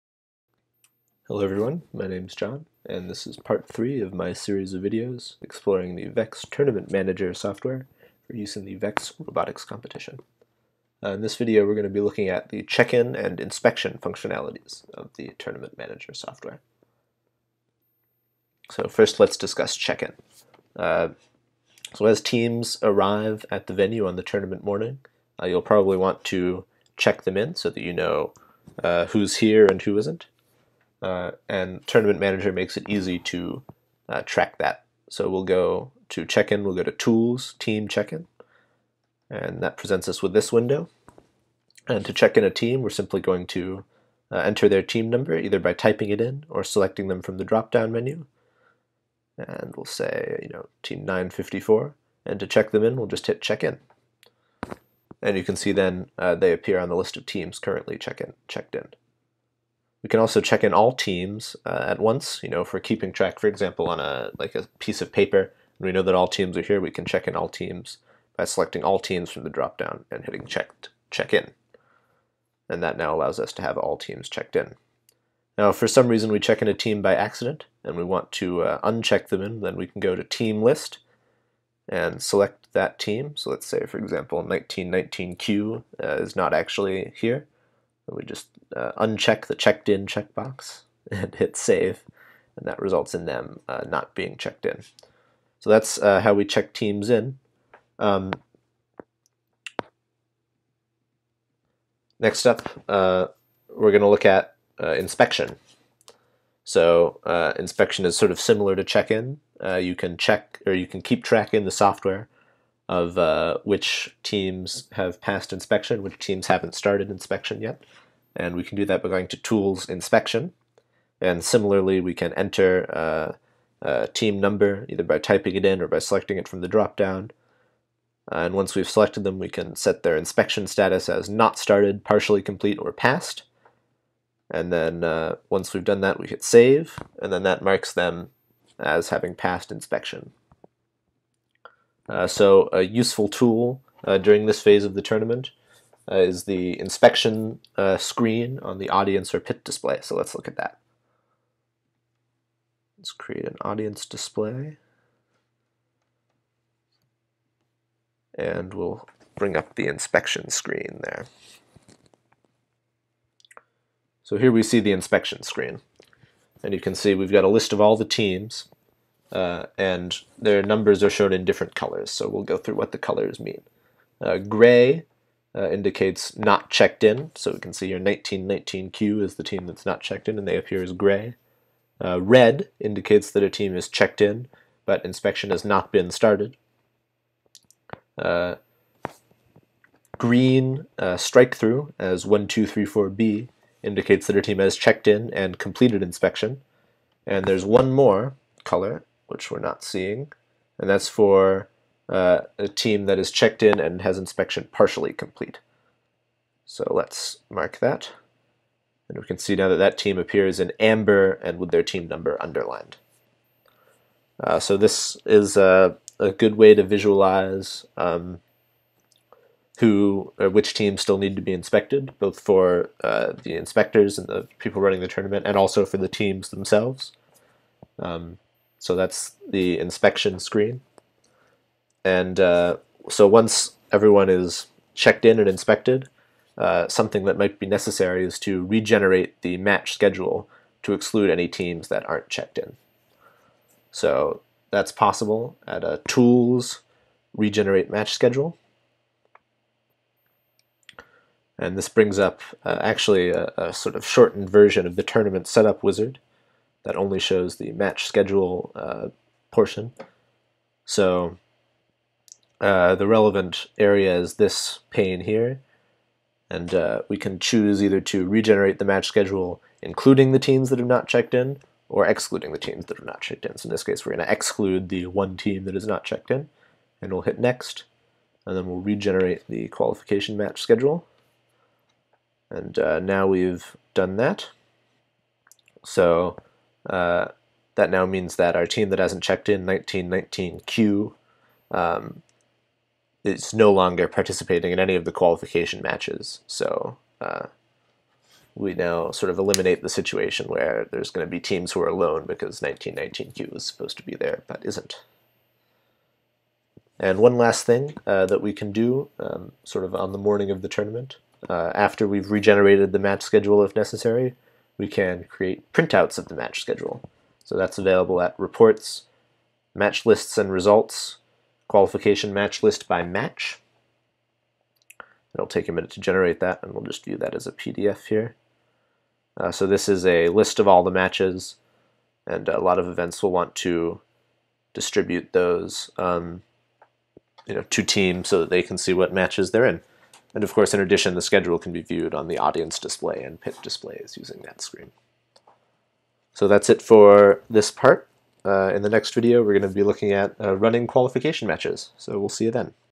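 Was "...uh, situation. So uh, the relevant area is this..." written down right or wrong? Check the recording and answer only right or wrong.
wrong.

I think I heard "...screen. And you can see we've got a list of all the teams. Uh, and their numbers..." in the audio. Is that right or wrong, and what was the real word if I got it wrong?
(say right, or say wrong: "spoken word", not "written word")
right.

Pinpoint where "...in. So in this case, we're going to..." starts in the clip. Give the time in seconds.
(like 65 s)
273 s.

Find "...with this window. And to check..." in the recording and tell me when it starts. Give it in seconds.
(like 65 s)
40 s.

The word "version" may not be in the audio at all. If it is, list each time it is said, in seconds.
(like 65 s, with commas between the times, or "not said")
254 s.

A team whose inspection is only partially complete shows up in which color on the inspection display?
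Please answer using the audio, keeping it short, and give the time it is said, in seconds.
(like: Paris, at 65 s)
Amber, at 210 s.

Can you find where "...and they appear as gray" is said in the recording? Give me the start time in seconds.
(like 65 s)
180 s.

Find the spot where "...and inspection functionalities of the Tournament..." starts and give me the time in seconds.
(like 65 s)
13 s.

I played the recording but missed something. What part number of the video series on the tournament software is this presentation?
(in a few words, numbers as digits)
3.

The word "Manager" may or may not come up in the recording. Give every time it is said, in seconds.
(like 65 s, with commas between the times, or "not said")
6 s, 15 s, 32 s.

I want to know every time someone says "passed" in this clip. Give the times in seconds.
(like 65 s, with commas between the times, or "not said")
115 s, 132 s, 139 s.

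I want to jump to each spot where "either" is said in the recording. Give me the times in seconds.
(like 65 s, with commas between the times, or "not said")
45 s, 124 s, 267 s.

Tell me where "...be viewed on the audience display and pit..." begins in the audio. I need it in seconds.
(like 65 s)
341 s.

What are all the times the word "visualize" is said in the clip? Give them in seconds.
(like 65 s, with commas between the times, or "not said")
216 s.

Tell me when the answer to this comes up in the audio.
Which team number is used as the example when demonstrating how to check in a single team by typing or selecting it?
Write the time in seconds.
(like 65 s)
50 s.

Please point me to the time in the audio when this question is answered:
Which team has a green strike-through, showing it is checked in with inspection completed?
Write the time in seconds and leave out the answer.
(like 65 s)
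192 s.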